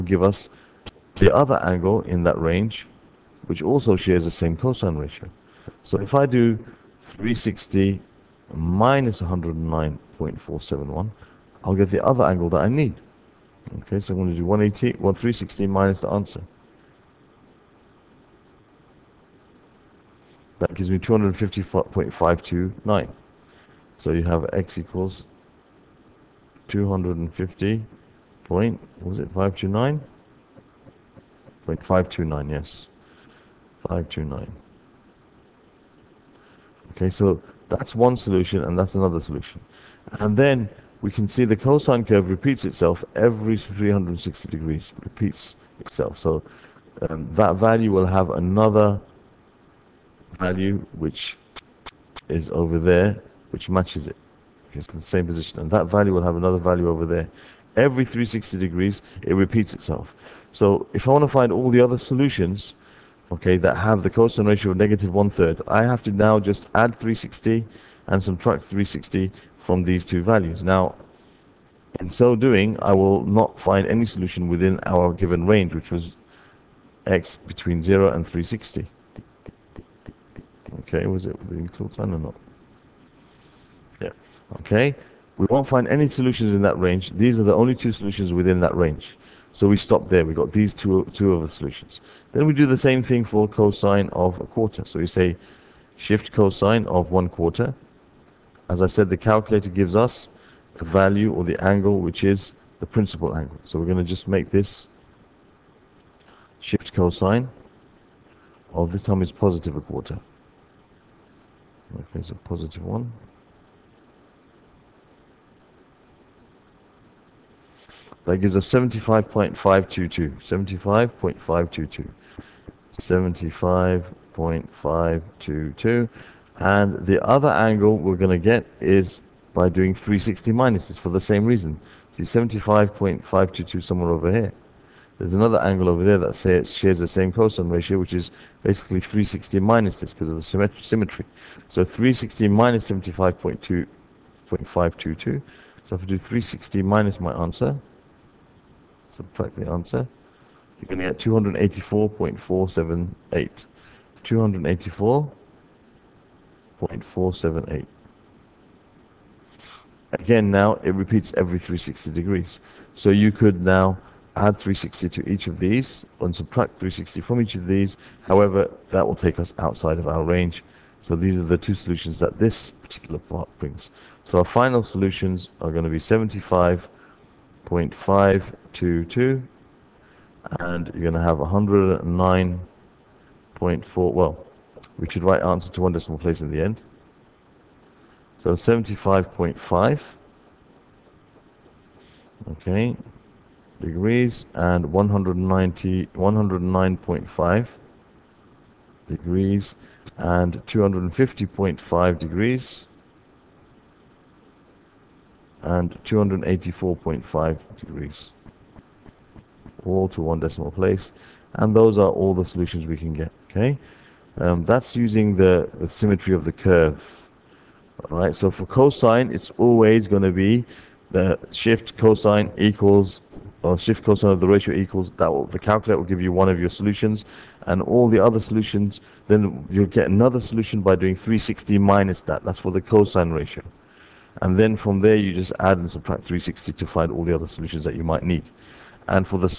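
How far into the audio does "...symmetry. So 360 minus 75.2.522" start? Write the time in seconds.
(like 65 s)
140 s.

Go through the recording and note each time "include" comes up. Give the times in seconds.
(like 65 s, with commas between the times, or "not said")
81 s.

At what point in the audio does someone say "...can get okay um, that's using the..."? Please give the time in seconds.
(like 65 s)
212 s.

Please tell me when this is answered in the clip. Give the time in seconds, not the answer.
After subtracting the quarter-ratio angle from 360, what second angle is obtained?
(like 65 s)
150 s.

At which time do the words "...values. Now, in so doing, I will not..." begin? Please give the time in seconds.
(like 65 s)
70 s.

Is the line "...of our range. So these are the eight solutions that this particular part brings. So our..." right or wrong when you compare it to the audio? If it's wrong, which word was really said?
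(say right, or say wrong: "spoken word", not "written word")
wrong: "two", not "eight".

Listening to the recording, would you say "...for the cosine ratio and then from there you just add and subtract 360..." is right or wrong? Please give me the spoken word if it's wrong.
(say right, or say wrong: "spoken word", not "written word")
right.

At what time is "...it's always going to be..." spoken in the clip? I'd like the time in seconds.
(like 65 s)
219 s.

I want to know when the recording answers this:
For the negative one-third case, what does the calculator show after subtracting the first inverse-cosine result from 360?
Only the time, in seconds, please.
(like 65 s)
20 s.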